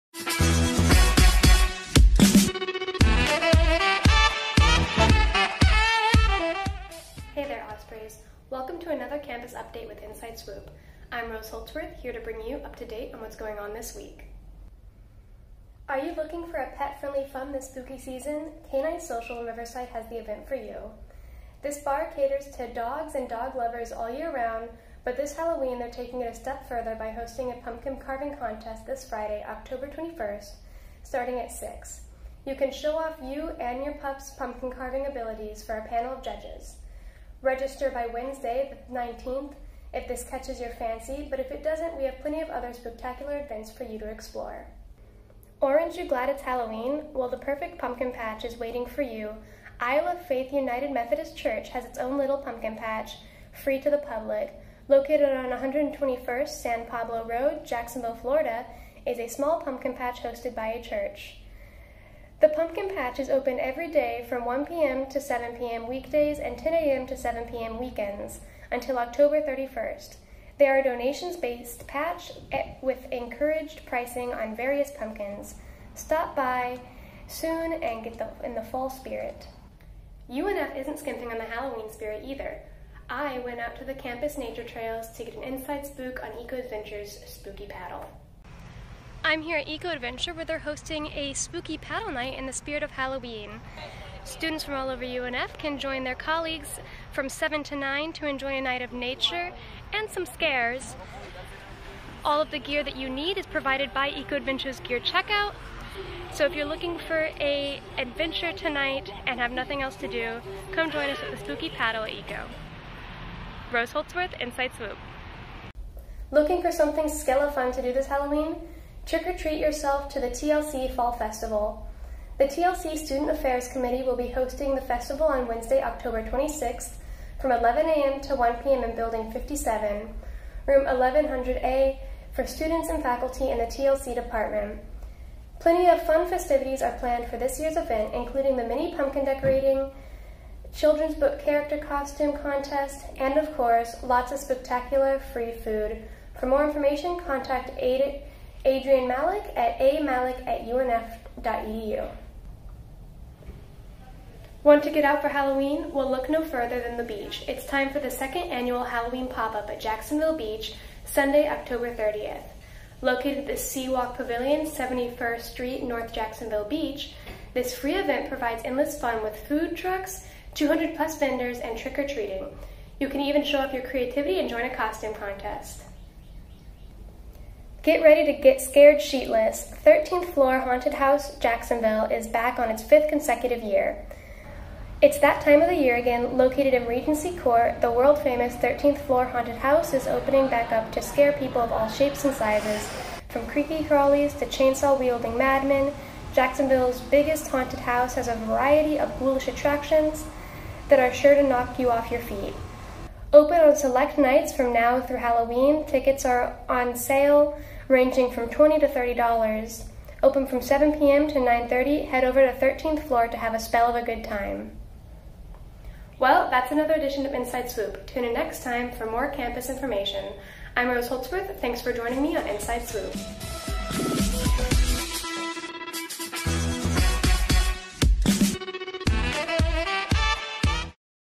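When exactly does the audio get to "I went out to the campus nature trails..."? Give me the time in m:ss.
1:23.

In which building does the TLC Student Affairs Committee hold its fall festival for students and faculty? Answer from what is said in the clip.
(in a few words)
Building 57.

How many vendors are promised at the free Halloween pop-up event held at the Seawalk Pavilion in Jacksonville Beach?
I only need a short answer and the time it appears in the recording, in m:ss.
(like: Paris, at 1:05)
200 plus, at 2:50.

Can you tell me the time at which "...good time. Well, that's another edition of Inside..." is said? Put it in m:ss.
3:34.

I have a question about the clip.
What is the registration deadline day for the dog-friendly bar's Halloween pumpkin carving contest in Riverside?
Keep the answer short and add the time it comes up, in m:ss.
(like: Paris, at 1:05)
Wednesday, the 19th, at 0:38.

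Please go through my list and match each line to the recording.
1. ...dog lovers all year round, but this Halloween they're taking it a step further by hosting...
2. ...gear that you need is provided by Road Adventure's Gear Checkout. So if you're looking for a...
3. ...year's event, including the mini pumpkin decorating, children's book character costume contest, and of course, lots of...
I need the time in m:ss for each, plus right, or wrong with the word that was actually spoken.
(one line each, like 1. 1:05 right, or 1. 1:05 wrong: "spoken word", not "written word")
1. 0:23 right
2. 1:42 wrong: "Eco", not "Road"
3. 2:17 right.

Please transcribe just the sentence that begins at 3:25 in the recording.
Tickets are on sale ranging from $20 to $30.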